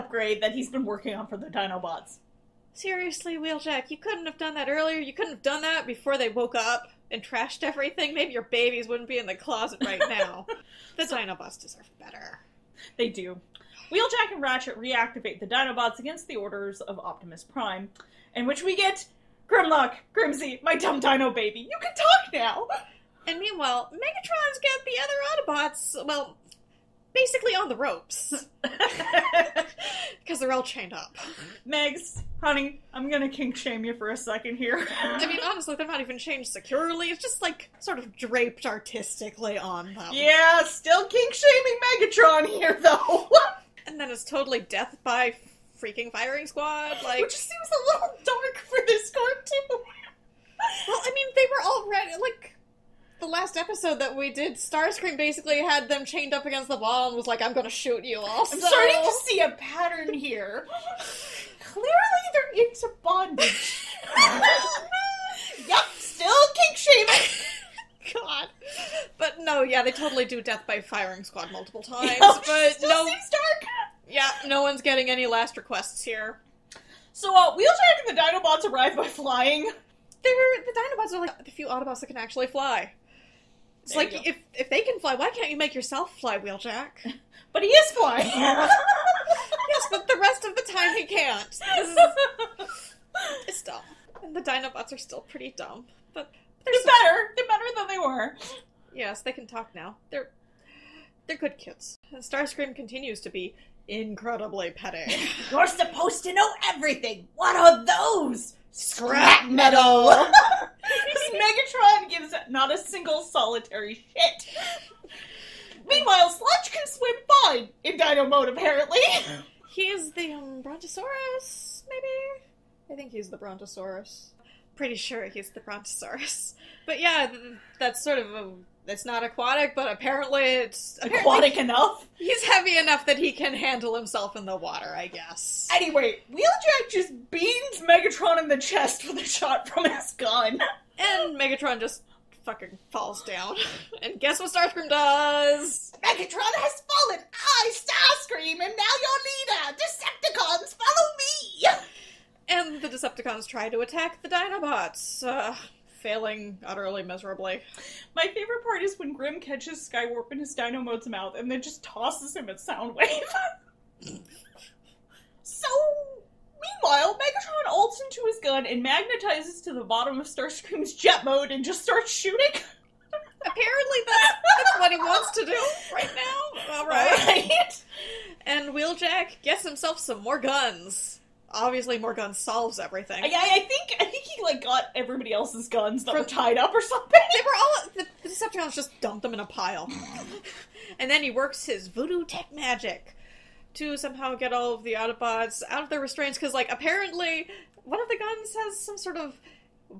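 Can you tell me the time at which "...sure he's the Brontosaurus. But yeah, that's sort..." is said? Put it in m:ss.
2:04.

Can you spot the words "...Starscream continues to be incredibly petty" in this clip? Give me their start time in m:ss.
1:42.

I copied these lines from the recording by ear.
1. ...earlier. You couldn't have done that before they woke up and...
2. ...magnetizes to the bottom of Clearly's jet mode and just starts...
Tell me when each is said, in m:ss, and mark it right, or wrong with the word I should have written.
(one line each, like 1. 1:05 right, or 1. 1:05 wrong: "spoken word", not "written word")
1. 0:04 right
2. 2:48 wrong: "Starscream", not "Clearly".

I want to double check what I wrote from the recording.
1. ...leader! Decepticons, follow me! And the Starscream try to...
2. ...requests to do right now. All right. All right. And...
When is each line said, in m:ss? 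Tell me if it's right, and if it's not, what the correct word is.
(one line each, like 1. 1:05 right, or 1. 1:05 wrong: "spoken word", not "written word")
1. 2:29 wrong: "Decepticons", not "Starscream"
2. 2:54 wrong: "wants", not "requests".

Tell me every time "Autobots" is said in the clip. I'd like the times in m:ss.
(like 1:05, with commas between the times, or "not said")
0:25, 1:21, 3:14.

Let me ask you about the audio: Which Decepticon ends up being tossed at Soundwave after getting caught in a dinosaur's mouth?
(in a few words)
Skywarp.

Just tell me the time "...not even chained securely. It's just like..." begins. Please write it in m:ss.
0:35.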